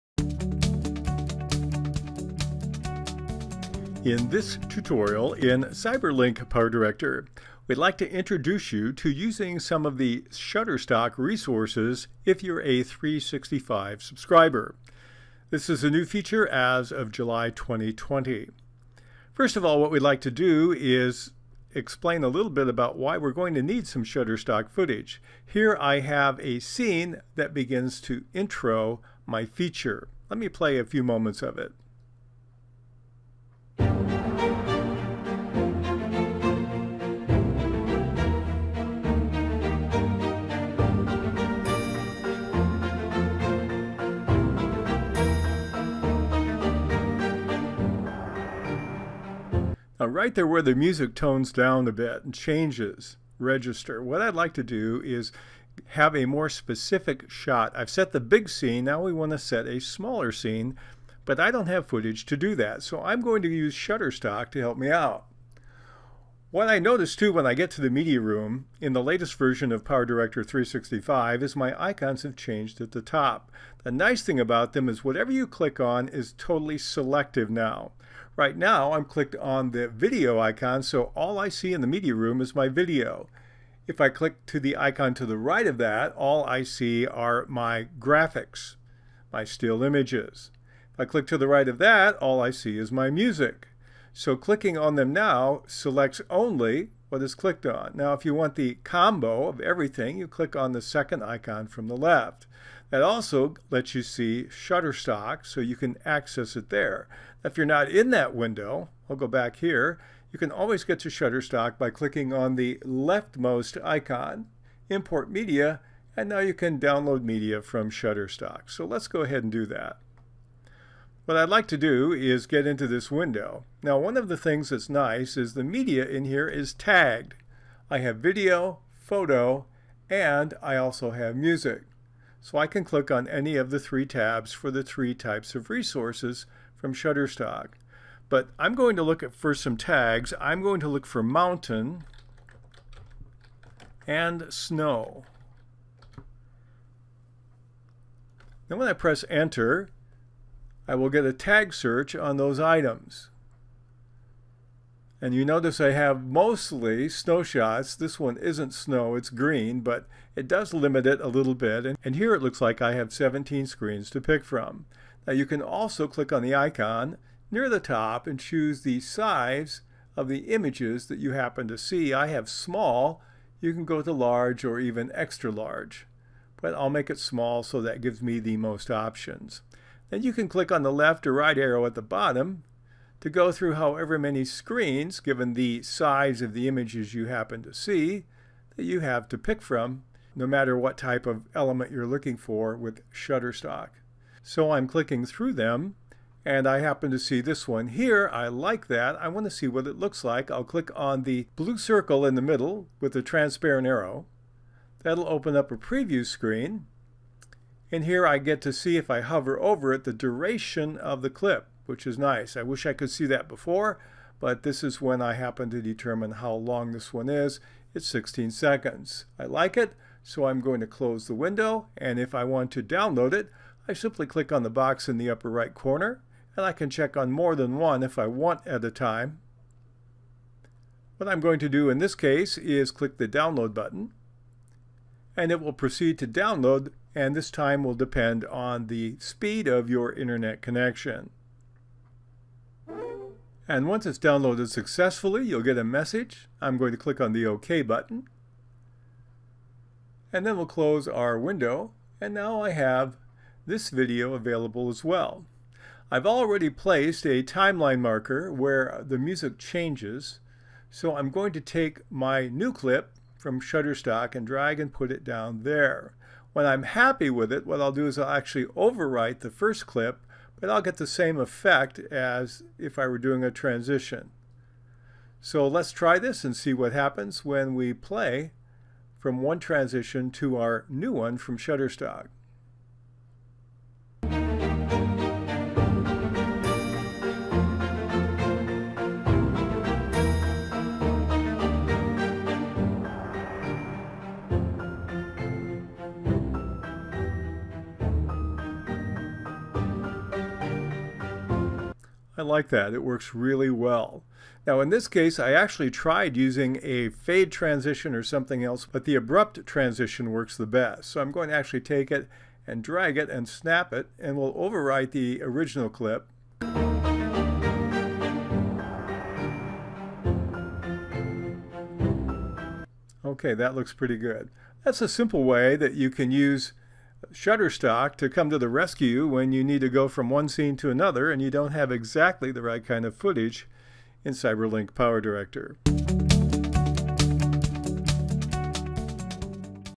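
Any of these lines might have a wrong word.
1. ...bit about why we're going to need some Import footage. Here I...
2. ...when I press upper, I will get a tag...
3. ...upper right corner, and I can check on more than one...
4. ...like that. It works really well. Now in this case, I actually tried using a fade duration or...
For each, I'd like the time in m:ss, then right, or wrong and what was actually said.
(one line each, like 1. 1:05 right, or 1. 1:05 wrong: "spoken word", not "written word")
1. 0:22 wrong: "Shutterstock", not "Import"
2. 2:28 wrong: "enter", not "upper"
3. 3:45 right
4. 5:02 wrong: "transition", not "duration".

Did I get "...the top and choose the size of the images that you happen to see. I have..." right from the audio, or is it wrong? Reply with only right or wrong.
right.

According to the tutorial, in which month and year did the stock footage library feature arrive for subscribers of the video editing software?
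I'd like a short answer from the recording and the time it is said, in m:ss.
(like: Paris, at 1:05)
July 2020, at 0:17.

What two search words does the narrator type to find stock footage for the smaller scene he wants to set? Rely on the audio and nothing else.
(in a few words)
mountain and snow.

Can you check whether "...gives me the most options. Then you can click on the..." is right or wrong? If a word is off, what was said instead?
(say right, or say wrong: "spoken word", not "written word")
right.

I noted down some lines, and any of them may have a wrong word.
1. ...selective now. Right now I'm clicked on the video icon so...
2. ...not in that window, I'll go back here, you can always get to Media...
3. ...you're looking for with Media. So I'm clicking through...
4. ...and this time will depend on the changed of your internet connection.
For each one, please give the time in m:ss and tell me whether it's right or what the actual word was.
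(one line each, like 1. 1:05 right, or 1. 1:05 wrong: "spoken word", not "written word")
1. 1:16 right
2. 1:47 wrong: "Shutterstock", not "Media"
3. 3:11 wrong: "Shutterstock", not "Media"
4. 3:57 wrong: "speed", not "changed".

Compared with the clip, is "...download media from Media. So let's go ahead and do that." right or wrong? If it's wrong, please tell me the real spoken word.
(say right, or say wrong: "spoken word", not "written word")
wrong: "Shutterstock", not "Media".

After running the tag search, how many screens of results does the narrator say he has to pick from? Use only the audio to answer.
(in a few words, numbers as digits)
17.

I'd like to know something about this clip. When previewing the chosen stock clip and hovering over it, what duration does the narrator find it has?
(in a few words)
16 seconds.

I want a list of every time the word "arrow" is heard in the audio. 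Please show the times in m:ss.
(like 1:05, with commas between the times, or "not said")
3:01, 3:23.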